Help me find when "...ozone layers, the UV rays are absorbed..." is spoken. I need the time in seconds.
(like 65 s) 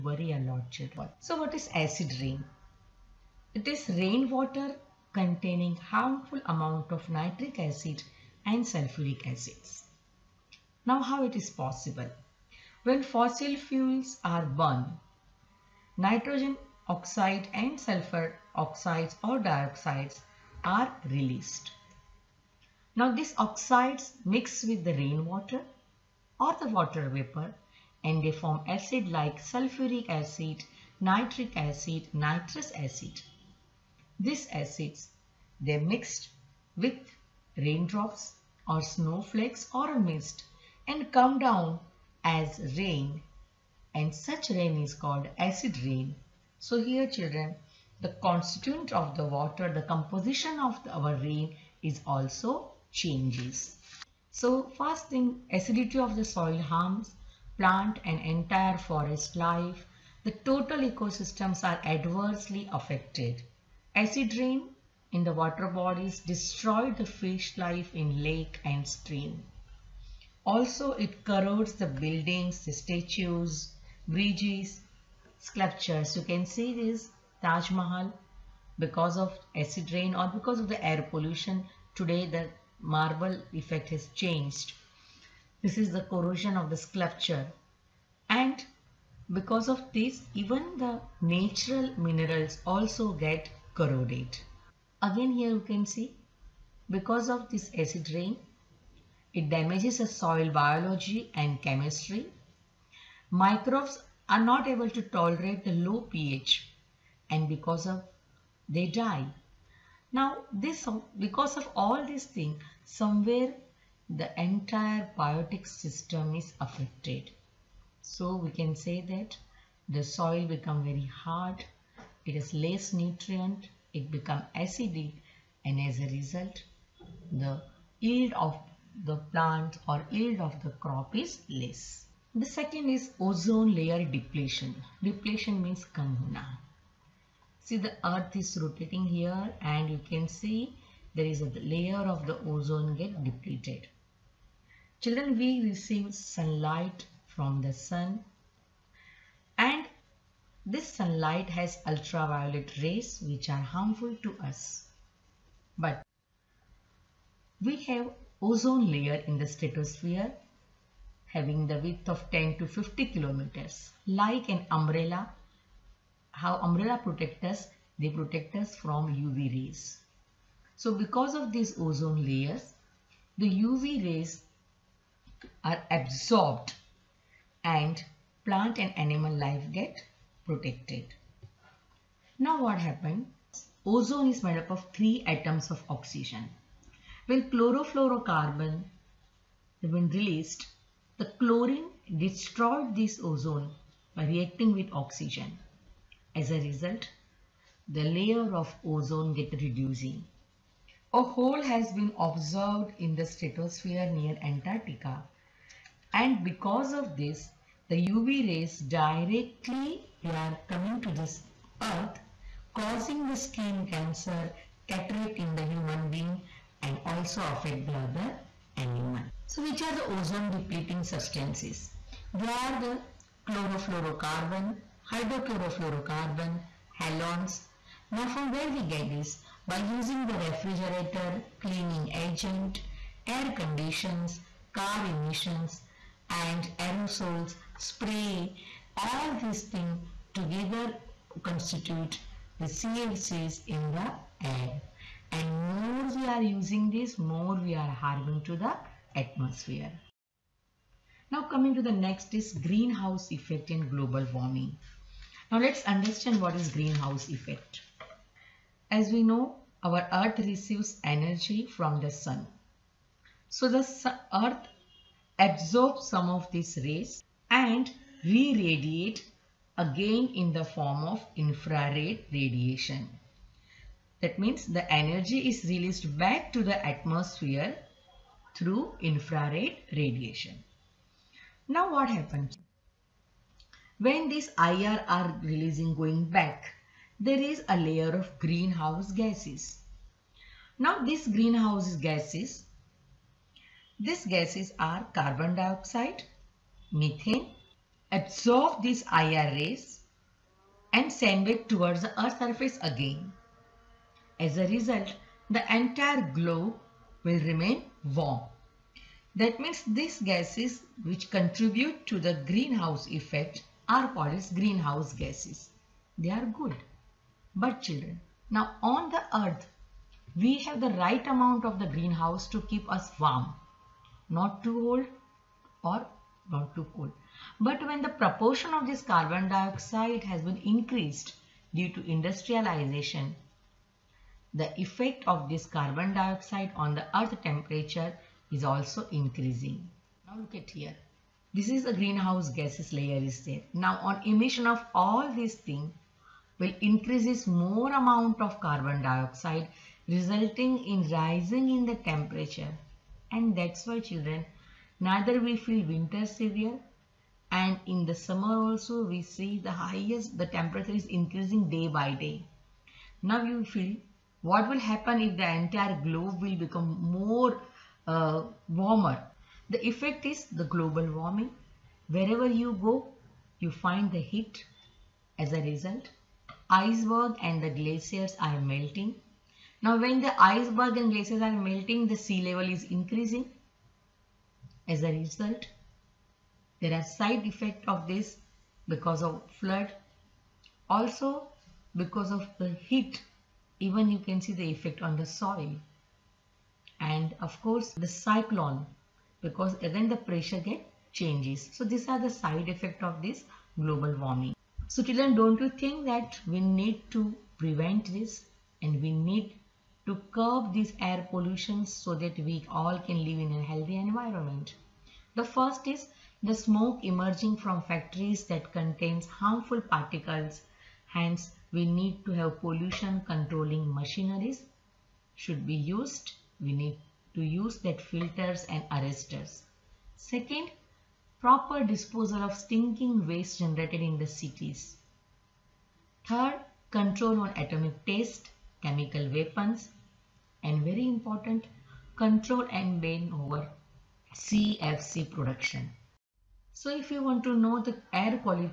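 171 s.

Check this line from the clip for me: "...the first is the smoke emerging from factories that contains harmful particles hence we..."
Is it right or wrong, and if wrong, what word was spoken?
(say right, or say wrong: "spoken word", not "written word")
right.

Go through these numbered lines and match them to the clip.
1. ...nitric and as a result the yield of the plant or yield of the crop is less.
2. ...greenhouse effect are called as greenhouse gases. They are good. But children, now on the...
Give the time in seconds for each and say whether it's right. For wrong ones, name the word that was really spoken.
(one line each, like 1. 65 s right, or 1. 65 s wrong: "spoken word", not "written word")
1. 124 s wrong: "acidic", not "nitric"
2. 312 s right.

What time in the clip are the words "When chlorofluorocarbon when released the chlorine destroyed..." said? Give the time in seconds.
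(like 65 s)
187 s.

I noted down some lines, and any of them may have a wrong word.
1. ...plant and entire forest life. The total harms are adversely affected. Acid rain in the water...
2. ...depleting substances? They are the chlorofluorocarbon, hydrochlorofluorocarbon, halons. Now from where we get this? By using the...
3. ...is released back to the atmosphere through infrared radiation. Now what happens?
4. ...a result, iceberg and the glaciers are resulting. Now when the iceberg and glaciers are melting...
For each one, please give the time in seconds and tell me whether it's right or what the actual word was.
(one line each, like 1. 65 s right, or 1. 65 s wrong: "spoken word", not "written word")
1. 57 s wrong: "ecosystems", not "harms"
2. 220 s right
3. 275 s right
4. 375 s wrong: "melting", not "resulting".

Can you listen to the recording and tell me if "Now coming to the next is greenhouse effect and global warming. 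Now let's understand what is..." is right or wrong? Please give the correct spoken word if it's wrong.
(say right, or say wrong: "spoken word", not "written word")
right.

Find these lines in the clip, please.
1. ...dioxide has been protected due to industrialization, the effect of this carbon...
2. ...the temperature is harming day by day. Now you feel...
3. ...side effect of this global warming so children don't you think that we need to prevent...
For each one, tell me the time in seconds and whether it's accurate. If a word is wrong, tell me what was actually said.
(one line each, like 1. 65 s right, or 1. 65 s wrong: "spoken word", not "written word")
1. 329 s wrong: "increased", not "protected"
2. 360 s wrong: "increasing", not "harming"
3. 402 s right.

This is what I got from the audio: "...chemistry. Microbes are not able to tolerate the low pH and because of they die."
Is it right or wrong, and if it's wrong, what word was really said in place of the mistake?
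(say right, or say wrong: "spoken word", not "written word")
right.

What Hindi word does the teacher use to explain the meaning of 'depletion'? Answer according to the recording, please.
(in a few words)
kahuna.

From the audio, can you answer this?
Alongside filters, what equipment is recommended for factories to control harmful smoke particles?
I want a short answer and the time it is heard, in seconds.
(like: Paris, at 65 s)
arresters, at 428 s.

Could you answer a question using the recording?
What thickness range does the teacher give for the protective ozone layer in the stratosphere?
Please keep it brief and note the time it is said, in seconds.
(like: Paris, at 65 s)
10 to 50 kilometers, at 162 s.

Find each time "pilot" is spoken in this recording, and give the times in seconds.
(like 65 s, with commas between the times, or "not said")
not said.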